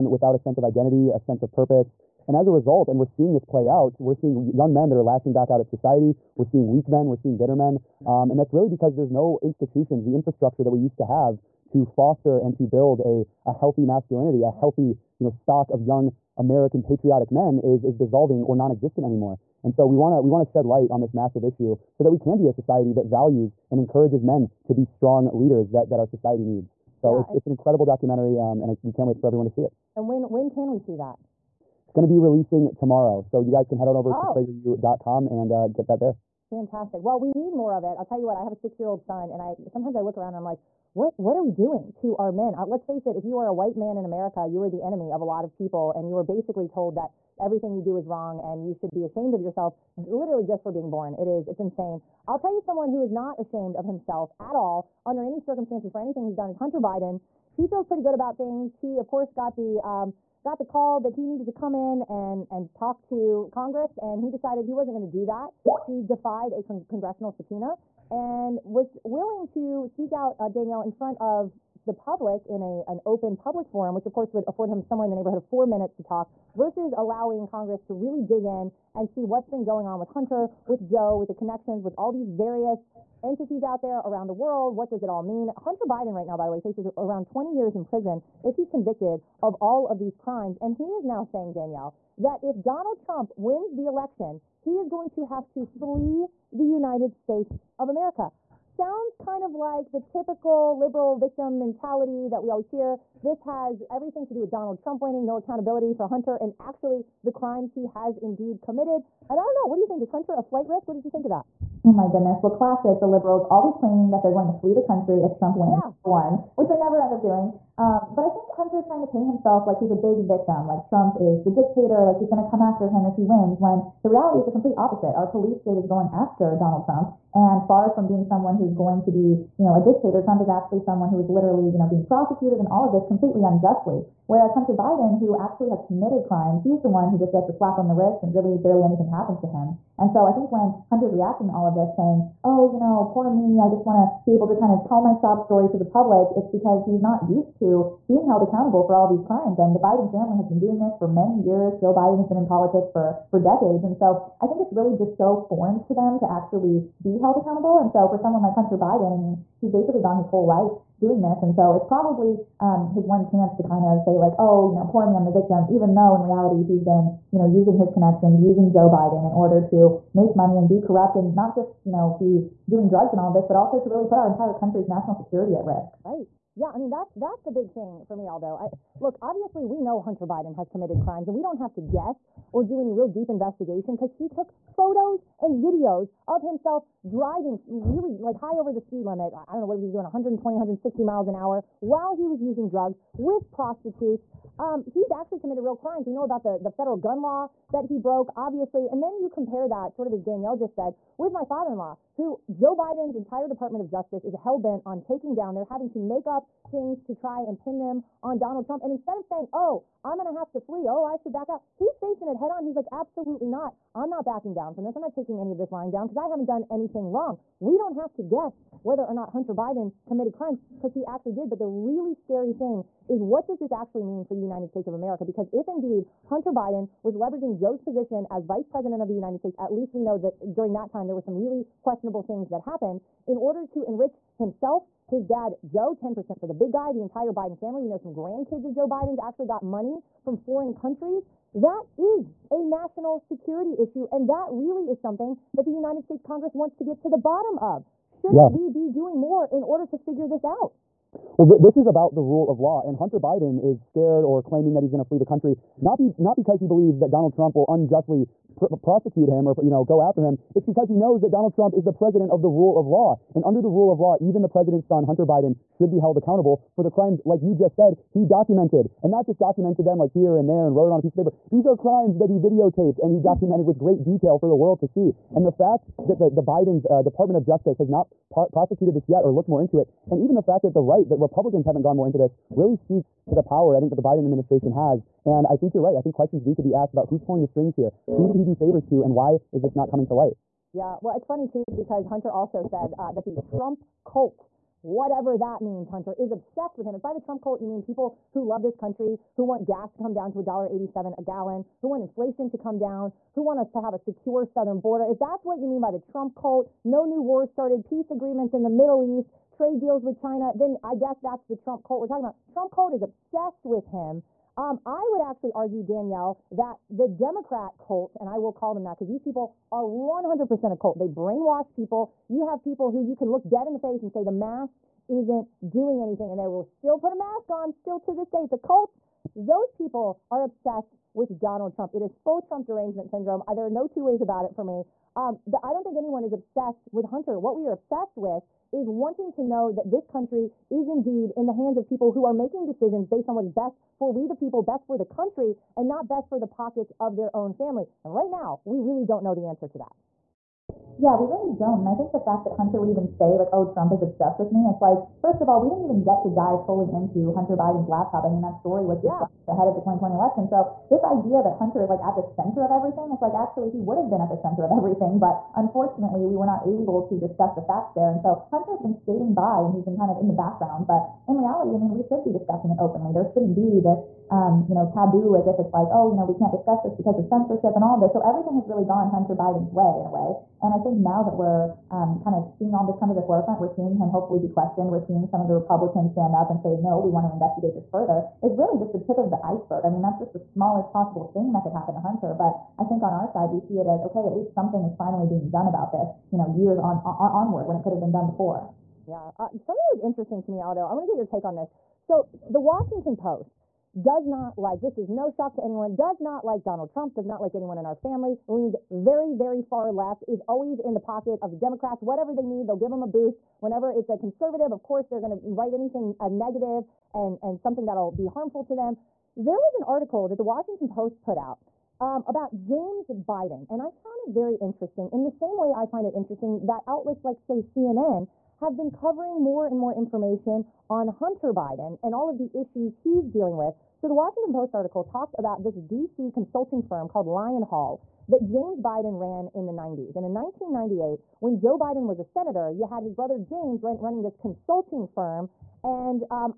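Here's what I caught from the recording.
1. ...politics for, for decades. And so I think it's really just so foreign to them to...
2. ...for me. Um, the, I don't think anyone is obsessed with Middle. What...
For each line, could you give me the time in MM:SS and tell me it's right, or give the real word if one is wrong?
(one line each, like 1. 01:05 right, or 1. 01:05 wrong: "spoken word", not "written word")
1. 02:32 right
2. 05:34 wrong: "Hunter", not "Middle".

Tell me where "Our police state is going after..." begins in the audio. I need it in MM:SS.
02:05.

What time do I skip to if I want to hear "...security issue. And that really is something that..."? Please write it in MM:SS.
04:03.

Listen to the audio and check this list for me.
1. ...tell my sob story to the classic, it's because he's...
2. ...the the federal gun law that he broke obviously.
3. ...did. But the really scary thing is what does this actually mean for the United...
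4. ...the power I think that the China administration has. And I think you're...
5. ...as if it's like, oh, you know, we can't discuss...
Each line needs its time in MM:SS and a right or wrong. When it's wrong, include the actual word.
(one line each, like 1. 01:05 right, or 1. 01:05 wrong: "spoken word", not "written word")
1. 02:24 wrong: "public", not "classic"
2. 03:16 right
3. 03:41 right
4. 04:43 wrong: "Biden", not "China"
5. 06:15 right.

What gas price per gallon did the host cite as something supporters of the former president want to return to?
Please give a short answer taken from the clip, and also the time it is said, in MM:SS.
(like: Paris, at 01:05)
$1.87, at 05:00.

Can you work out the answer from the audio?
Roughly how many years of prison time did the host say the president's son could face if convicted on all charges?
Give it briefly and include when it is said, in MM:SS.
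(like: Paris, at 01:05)
20 years, at 01:27.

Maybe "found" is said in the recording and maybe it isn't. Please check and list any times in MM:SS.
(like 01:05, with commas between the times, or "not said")
07:03.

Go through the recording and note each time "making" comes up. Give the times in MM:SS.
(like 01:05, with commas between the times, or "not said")
05:42.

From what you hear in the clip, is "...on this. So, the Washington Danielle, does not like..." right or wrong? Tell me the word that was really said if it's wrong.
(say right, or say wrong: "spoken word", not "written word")
wrong: "Post", not "Danielle".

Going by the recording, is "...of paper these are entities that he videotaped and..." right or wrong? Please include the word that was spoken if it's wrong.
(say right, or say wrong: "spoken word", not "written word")
wrong: "crimes", not "entities".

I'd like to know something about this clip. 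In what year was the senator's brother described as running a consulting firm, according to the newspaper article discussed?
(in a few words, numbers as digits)
1998.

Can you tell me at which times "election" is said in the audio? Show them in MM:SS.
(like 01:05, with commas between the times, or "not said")
01:33, 06:00.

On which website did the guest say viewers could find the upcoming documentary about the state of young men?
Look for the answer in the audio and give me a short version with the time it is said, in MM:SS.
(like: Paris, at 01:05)
PragerU.com, at 00:34.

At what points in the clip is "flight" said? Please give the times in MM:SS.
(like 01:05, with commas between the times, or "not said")
01:50.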